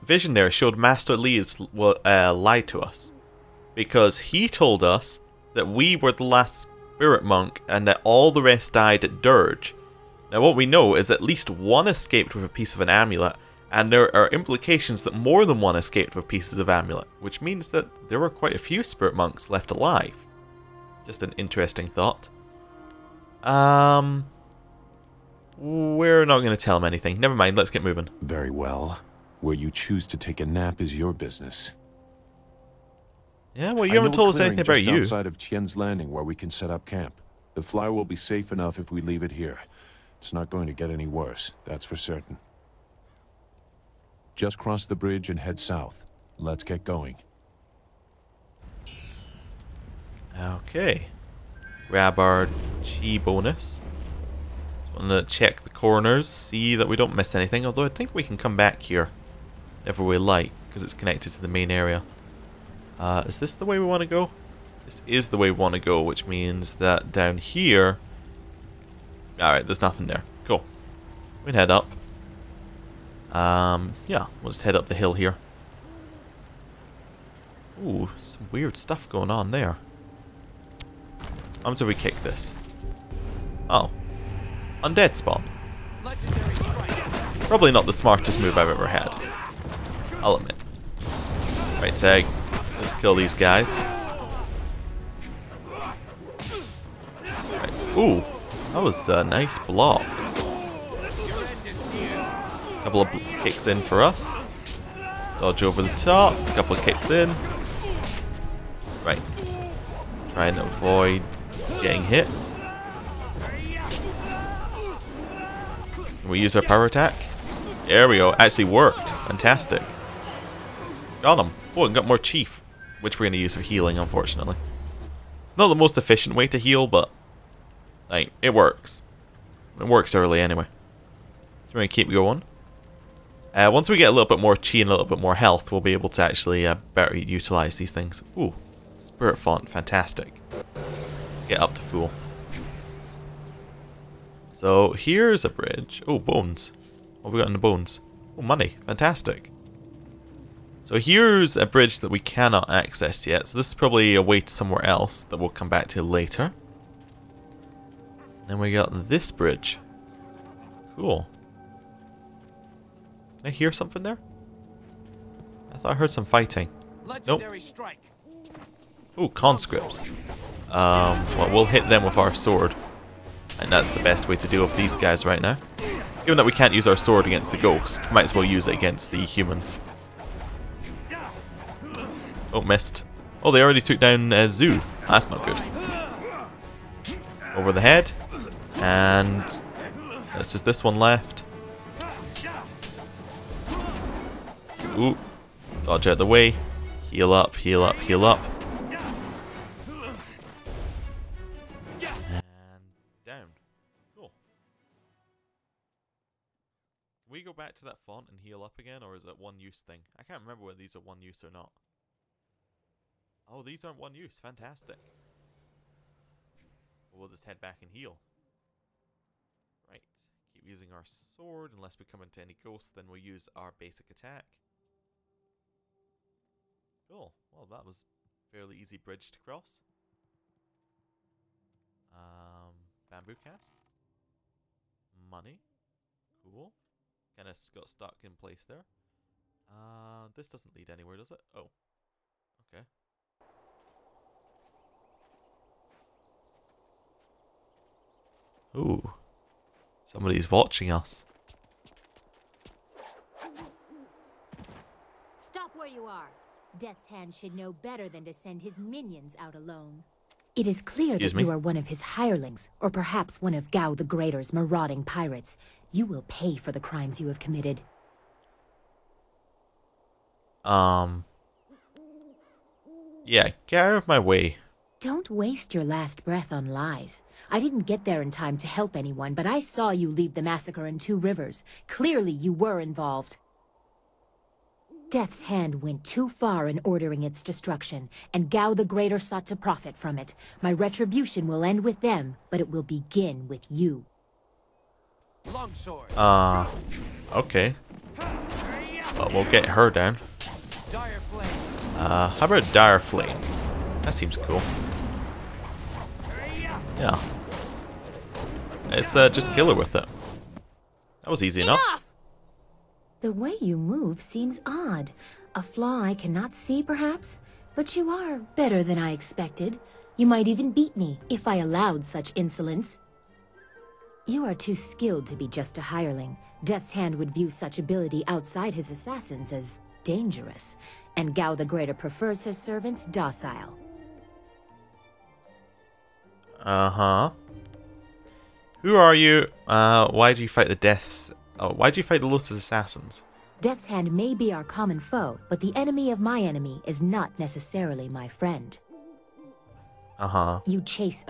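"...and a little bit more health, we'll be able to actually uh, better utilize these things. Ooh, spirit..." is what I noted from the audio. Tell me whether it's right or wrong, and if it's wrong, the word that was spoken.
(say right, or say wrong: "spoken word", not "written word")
right.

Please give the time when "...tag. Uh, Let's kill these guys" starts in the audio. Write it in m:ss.
1:31.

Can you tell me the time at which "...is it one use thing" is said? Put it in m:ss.
3:29.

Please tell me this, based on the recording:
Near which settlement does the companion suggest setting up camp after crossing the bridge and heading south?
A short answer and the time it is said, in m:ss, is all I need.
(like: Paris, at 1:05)
Tien's Landing, at 0:35.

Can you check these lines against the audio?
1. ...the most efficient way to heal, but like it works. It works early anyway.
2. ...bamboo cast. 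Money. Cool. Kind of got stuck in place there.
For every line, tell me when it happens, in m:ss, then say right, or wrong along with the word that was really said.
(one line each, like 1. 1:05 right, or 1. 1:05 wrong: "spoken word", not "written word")
1. 2:05 right
2. 3:53 right.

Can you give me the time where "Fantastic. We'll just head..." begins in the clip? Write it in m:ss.
3:34.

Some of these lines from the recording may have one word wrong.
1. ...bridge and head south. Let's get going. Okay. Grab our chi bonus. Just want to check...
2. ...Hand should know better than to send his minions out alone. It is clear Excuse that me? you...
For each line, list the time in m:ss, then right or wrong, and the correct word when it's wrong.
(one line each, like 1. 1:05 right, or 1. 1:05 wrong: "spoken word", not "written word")
1. 0:44 right
2. 4:17 right.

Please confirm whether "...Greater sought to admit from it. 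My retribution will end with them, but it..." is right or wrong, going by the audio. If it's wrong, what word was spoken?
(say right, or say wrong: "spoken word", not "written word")
wrong: "profit", not "admit".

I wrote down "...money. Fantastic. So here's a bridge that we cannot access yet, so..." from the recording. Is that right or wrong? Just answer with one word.
right.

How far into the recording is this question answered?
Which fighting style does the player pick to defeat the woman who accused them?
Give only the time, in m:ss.
5:02.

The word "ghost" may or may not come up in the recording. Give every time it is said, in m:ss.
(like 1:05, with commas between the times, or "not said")
2:57, 3:42.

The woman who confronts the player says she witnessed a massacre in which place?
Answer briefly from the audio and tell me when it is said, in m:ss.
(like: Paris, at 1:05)
Two Rivers, at 4:40.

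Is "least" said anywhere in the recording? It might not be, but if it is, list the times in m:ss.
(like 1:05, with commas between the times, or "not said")
0:11.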